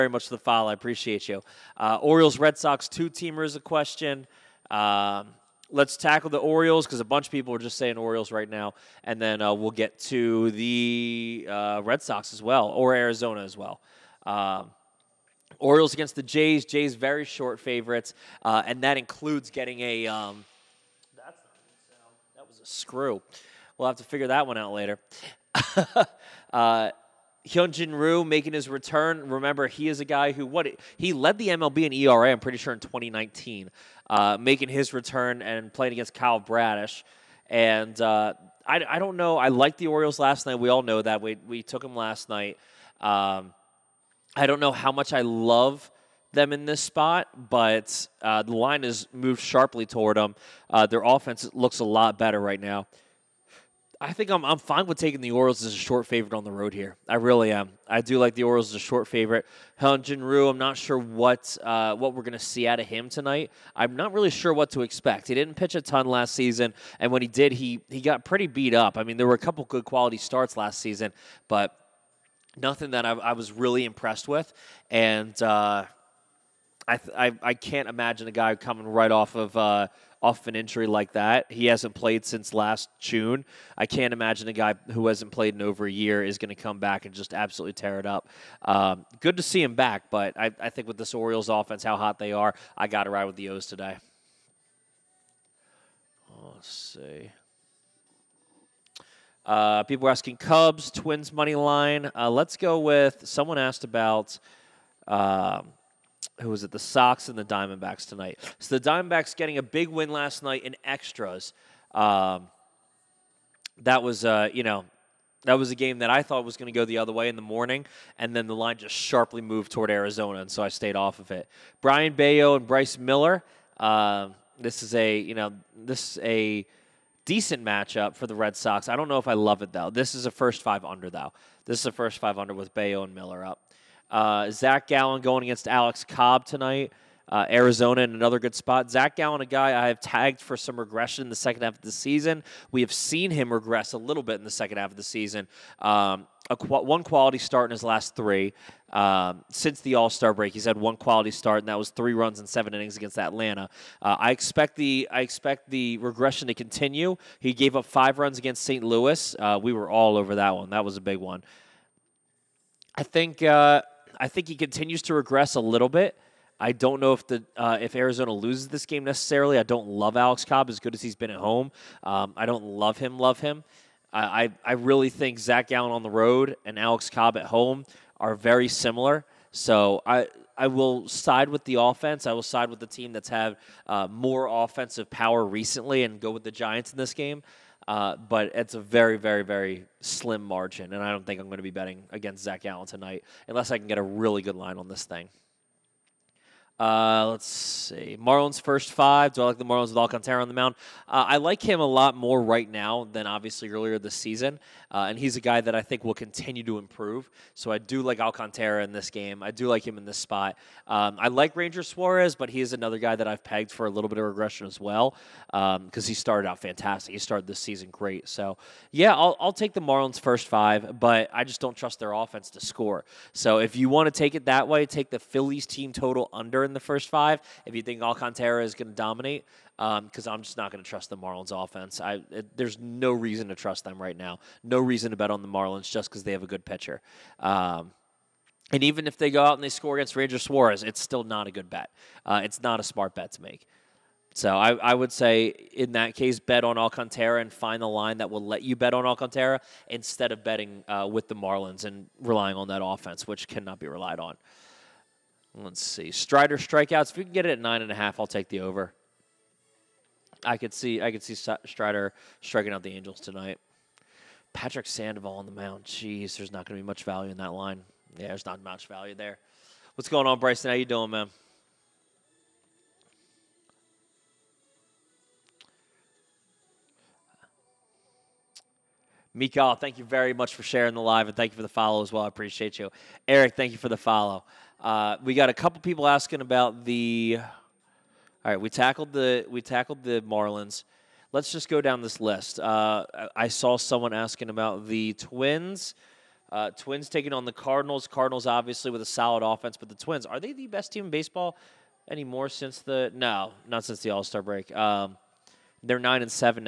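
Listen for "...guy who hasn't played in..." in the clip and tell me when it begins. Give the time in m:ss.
1:24.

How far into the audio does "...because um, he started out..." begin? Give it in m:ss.
3:35.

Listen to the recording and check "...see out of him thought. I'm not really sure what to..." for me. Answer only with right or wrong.
wrong.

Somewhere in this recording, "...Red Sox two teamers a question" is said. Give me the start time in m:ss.
0:02.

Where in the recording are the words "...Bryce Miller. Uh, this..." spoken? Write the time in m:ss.
2:02.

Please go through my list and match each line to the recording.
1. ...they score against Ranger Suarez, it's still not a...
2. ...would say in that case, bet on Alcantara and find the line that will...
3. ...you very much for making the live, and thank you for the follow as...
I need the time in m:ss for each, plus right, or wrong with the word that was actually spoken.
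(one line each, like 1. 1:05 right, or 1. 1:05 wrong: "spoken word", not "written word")
1. 3:59 right
2. 4:04 right
3. 4:39 wrong: "sharing", not "making".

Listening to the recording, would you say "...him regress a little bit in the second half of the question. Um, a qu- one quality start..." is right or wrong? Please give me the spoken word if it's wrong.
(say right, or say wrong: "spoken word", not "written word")
wrong: "season", not "question".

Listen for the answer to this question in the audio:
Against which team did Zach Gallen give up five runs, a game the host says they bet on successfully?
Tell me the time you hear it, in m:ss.
2:38.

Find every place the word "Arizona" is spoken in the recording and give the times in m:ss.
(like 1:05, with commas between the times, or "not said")
0:12, 1:59, 2:17, 2:47.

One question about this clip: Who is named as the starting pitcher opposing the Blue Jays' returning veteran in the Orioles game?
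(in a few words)
Kyle Bradish.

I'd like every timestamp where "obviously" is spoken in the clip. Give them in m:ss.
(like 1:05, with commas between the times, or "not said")
3:23, 4:58.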